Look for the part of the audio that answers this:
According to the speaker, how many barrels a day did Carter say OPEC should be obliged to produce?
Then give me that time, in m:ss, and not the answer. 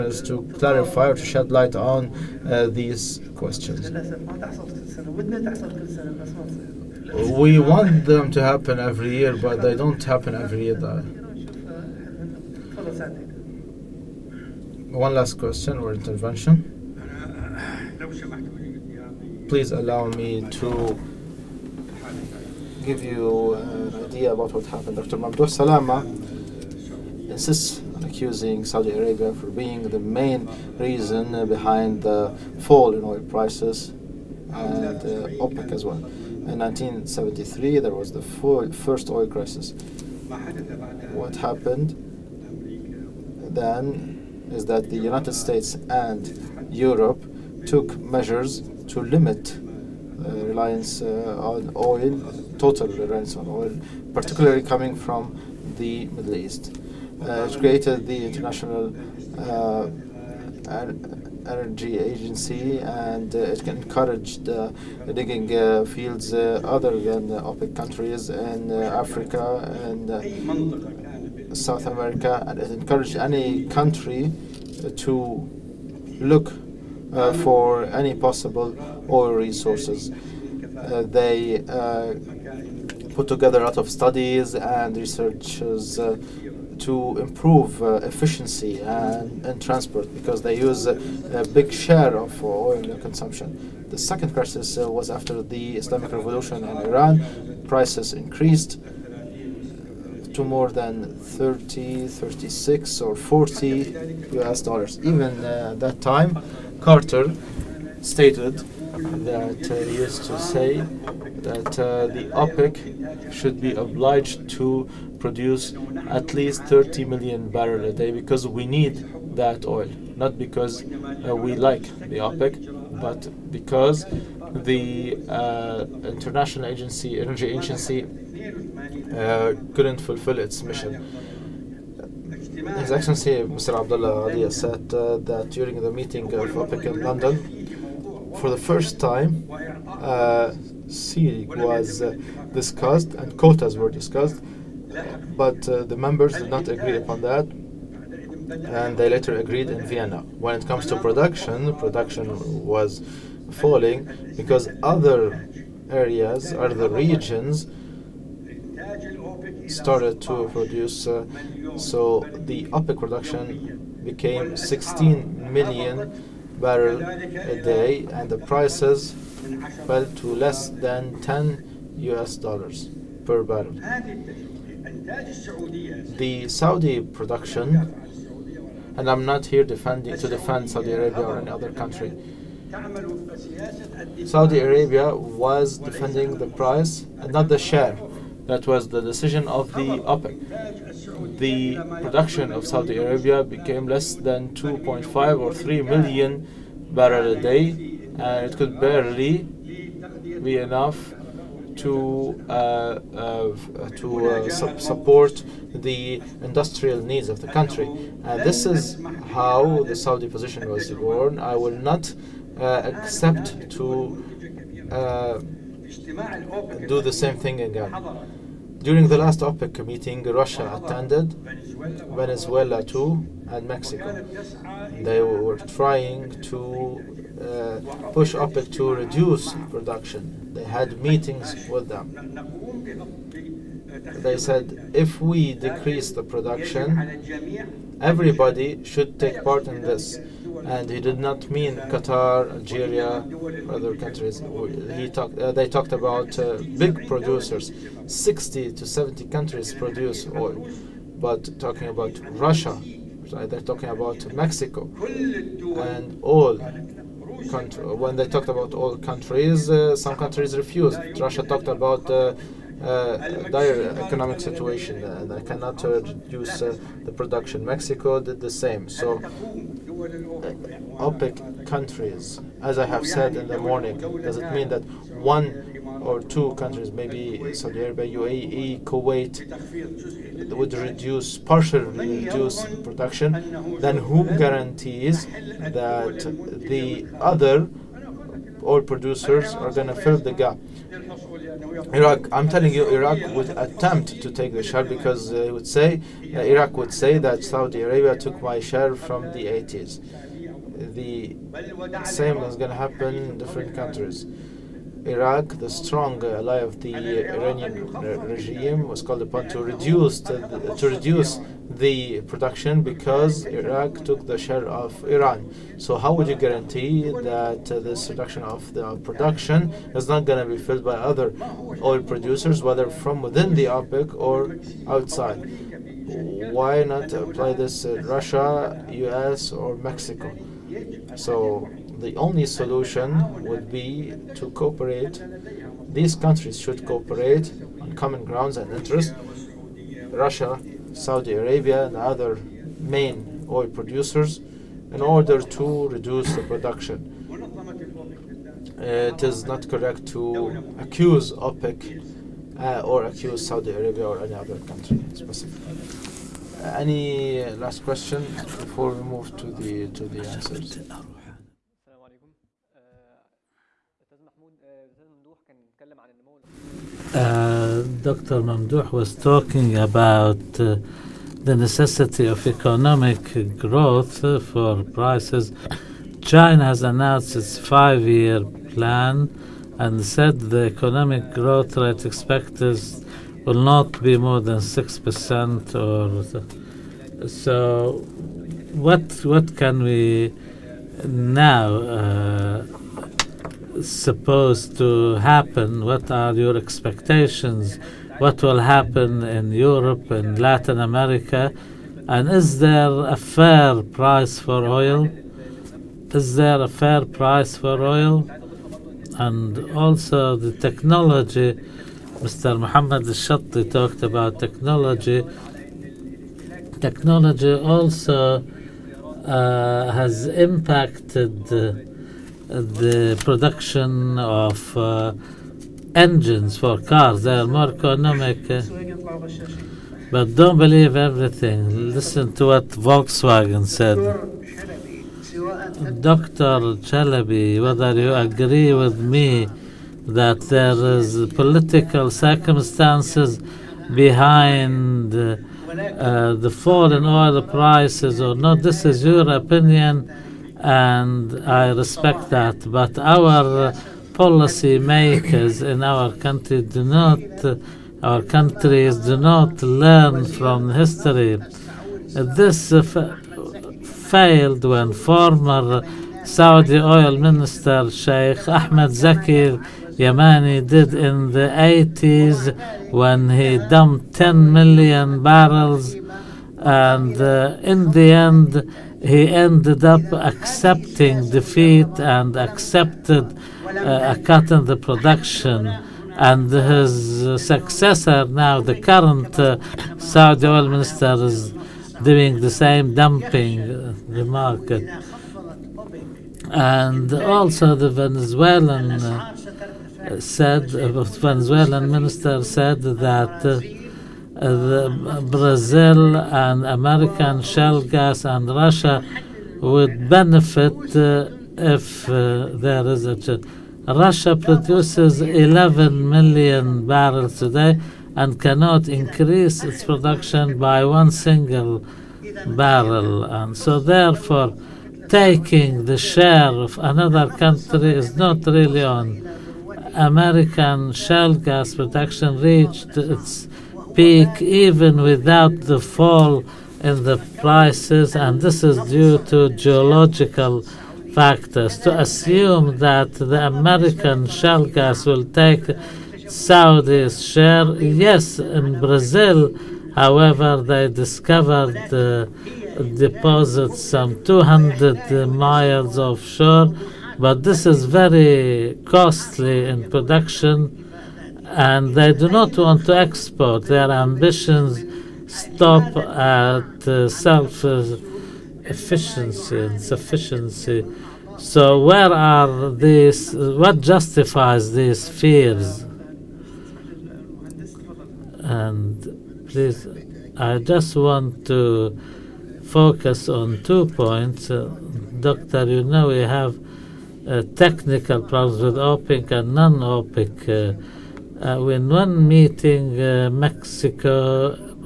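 1:56.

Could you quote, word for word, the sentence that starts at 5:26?
Why not apply this to Russia, U.S., or Mexico?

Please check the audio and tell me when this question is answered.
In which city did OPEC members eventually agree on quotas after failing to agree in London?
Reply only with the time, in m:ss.
2:29.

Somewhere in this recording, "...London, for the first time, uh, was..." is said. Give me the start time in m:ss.
2:17.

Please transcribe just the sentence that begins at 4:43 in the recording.
Then who guarantees that the other oil producers are going to fill the gap?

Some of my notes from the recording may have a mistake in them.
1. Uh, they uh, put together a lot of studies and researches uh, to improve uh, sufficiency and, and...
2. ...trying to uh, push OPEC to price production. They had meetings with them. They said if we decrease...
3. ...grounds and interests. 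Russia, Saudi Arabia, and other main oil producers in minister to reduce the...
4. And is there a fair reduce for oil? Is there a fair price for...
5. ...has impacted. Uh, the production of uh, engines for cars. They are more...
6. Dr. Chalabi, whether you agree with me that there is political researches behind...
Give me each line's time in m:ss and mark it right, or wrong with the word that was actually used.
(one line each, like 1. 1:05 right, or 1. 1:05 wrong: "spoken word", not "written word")
1. 1:20 wrong: "efficiency", not "sufficiency"
2. 3:45 wrong: "reduce", not "price"
3. 5:38 wrong: "order", not "minister"
4. 6:42 wrong: "price", not "reduce"
5. 6:59 right
6. 7:16 wrong: "circumstances", not "researches".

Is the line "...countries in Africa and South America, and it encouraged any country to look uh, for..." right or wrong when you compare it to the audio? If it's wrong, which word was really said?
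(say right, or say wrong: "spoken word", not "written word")
right.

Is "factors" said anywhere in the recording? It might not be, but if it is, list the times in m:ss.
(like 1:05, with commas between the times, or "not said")
9:01.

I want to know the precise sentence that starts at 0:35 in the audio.
In 1973, there was the first oil crisis.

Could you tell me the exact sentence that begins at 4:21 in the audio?
Russia talked about uh, uh, dire economic situation and they cannot reduce uh, the production.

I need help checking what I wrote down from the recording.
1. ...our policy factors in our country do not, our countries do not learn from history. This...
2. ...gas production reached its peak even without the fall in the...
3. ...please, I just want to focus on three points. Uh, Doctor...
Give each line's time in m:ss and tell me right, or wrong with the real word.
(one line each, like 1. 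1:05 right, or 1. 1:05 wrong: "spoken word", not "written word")
1. 7:32 wrong: "makers", not "factors"
2. 8:51 right
3. 9:39 wrong: "two", not "three".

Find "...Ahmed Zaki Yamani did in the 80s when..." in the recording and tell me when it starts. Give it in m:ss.
7:48.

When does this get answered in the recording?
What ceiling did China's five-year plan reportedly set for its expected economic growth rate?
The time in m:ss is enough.
6:24.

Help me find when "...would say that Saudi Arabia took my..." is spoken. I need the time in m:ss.
4:56.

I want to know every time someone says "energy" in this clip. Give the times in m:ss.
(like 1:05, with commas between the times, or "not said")
1:01, 2:07.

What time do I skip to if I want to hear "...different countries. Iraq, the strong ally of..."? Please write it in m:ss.
5:03.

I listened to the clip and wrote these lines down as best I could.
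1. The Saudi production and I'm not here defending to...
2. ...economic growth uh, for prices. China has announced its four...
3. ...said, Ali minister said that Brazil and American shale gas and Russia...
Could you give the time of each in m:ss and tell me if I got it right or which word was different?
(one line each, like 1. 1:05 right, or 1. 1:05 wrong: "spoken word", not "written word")
1. 2:56 right
2. 6:12 wrong: "five", not "four"
3. 8:20 wrong: "Venezuelan", not "Ali".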